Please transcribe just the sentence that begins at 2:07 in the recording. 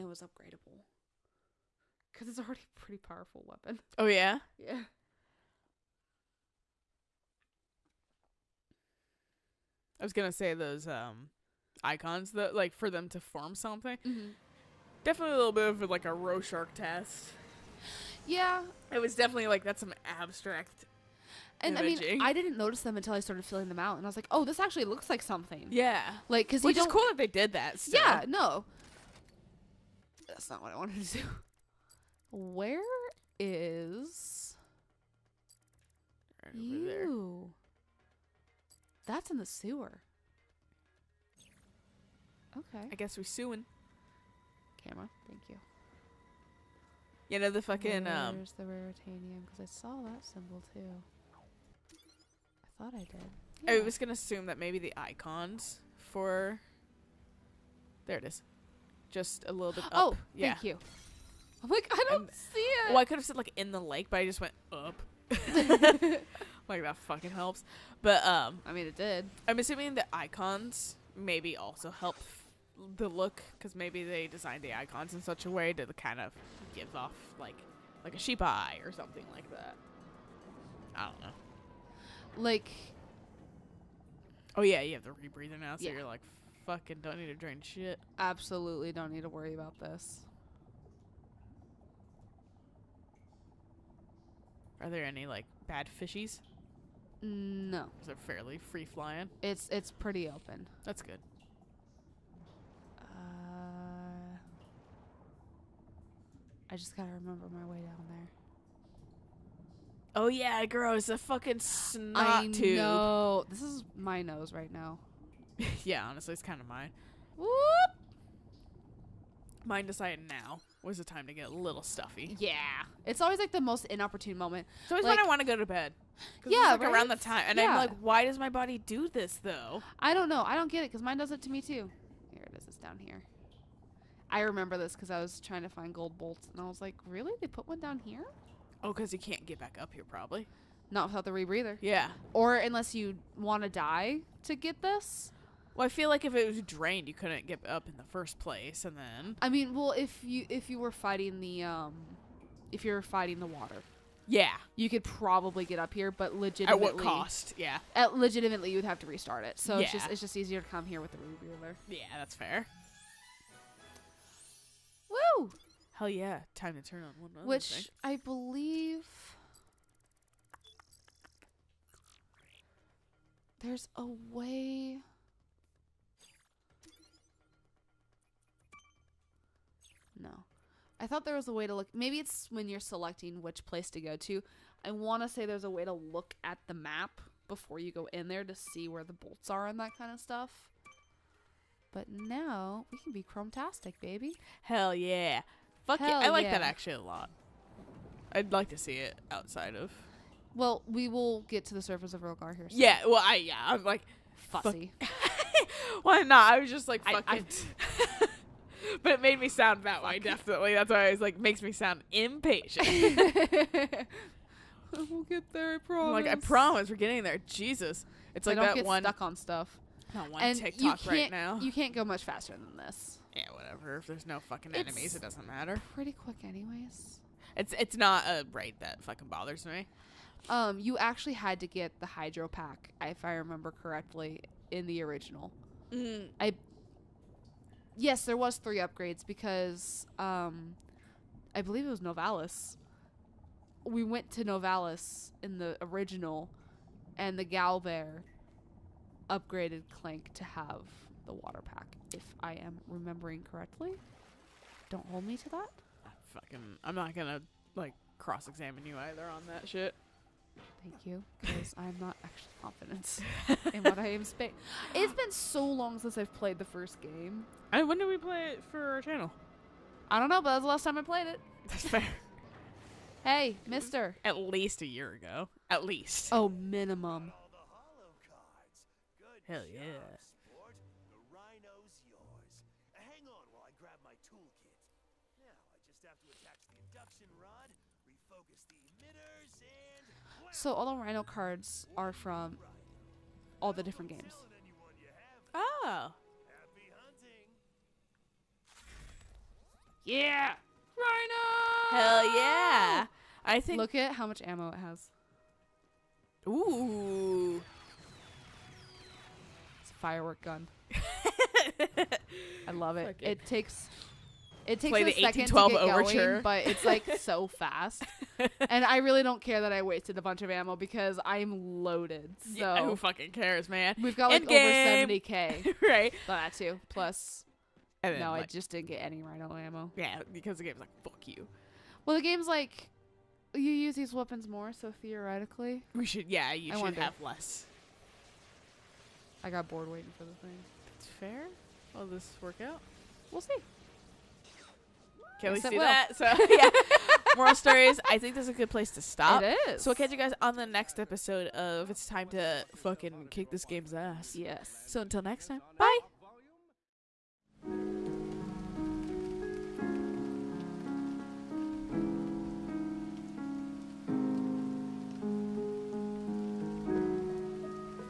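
I'm like, why does my body do this though?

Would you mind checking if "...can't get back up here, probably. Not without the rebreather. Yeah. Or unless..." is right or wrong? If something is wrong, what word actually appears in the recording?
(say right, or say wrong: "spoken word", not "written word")
right.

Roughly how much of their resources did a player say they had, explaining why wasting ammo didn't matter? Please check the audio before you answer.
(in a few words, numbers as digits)
over 70k.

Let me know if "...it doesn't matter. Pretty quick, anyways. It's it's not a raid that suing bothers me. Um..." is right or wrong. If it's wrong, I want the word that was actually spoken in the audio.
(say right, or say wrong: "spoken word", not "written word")
wrong: "fucking", not "suing".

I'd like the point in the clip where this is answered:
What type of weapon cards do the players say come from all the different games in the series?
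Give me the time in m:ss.
4:51.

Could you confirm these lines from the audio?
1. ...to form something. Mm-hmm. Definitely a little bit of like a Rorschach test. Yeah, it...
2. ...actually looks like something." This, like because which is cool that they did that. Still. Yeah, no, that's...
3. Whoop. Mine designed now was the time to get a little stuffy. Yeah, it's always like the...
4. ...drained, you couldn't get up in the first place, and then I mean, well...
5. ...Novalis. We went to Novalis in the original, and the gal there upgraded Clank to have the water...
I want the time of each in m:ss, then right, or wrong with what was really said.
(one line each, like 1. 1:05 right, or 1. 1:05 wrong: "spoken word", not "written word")
1. 0:13 right
2. 0:24 wrong: "Yeah", not "This"
3. 1:57 wrong: "decided", not "designed"
4. 2:26 right
5. 4:01 right.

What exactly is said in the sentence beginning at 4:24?
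It's been so long since I've played the first game.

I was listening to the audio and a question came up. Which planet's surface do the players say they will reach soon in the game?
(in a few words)
Rogar.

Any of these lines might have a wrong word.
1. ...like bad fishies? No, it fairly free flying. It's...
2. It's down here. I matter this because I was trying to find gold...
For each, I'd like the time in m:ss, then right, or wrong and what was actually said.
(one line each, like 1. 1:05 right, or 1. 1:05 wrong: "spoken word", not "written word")
1. 1:35 right
2. 2:12 wrong: "remember", not "matter".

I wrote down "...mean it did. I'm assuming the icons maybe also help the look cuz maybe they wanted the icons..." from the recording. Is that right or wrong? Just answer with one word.
wrong.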